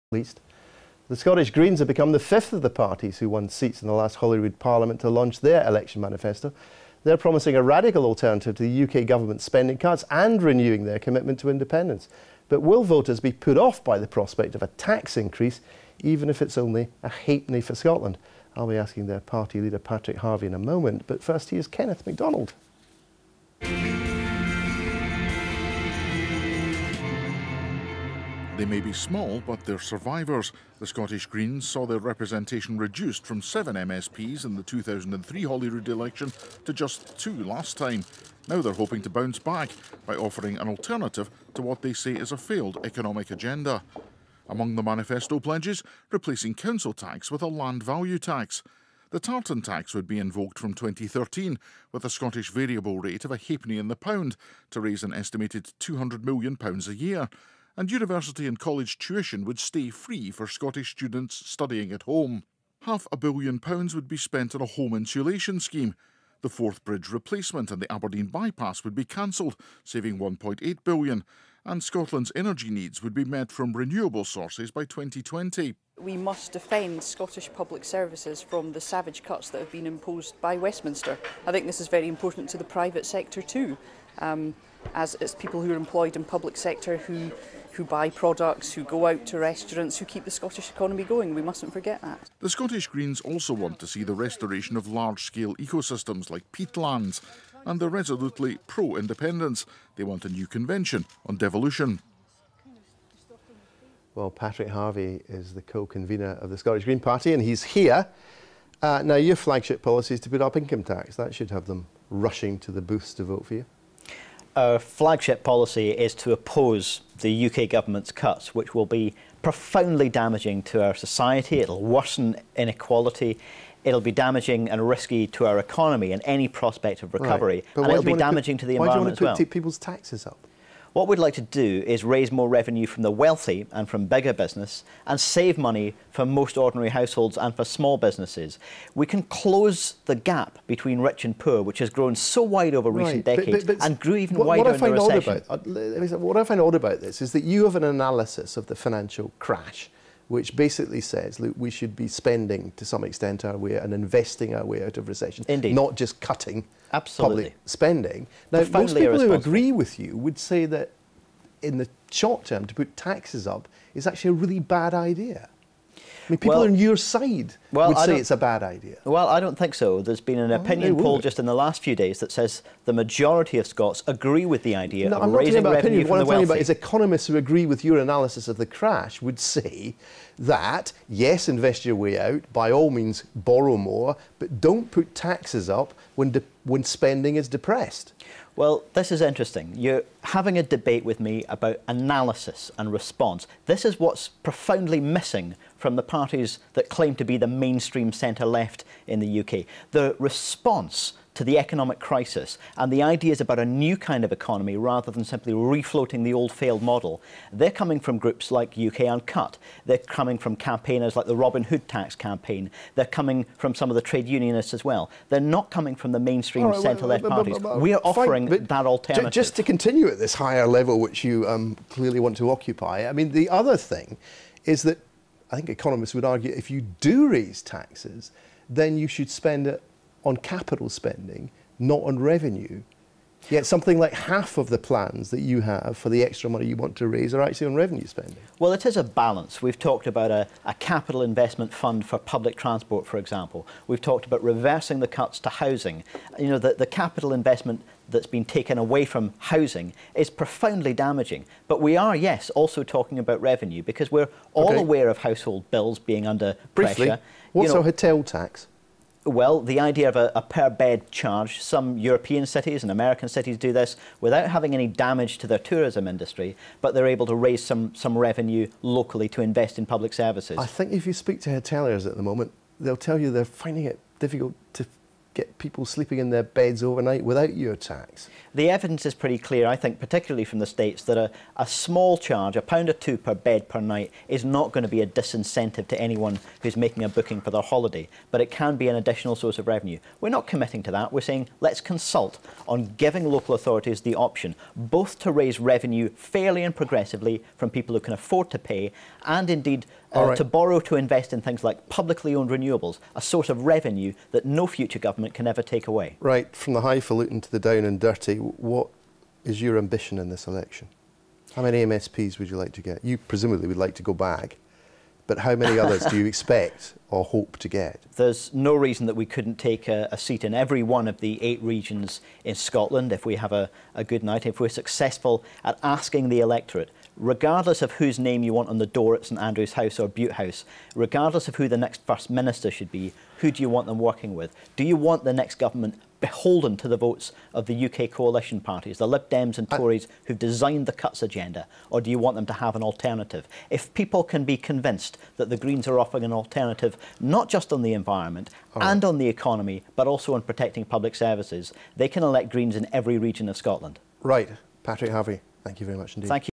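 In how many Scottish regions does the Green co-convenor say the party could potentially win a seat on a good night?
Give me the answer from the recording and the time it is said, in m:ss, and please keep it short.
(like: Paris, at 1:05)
8, at 5:21.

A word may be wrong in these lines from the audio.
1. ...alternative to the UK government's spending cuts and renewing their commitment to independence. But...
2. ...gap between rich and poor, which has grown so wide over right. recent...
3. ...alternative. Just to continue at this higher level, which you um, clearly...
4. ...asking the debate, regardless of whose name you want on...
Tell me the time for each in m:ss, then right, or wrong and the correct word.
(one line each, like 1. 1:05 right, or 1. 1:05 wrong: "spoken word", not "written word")
1. 0:08 right
2. 2:20 right
3. 3:38 right
4. 5:25 wrong: "electorate", not "debate".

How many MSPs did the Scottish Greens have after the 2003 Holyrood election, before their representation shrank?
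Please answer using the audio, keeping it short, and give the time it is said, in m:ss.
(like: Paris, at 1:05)
7, at 0:33.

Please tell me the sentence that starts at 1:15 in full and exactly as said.
We must defend Scottish public services from the savage cuts that have been imposed by Westminster.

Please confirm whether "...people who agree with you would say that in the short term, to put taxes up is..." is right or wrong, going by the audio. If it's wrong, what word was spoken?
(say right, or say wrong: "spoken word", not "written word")
right.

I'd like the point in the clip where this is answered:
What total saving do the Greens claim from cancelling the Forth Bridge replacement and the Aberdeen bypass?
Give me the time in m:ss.
1:10.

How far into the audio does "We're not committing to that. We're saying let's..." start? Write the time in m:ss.
4:50.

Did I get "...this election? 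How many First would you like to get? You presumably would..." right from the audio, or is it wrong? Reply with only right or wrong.
wrong.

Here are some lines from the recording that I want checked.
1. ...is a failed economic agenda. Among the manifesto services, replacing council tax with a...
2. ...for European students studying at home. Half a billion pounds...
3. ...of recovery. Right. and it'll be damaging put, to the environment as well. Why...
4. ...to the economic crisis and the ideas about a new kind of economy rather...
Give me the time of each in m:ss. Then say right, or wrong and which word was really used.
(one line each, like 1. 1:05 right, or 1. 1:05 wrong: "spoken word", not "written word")
1. 0:42 wrong: "pledges", not "services"
2. 1:00 wrong: "Scottish", not "European"
3. 2:07 right
4. 3:21 right.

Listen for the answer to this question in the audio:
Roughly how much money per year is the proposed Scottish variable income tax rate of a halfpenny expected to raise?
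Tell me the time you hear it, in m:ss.
0:55.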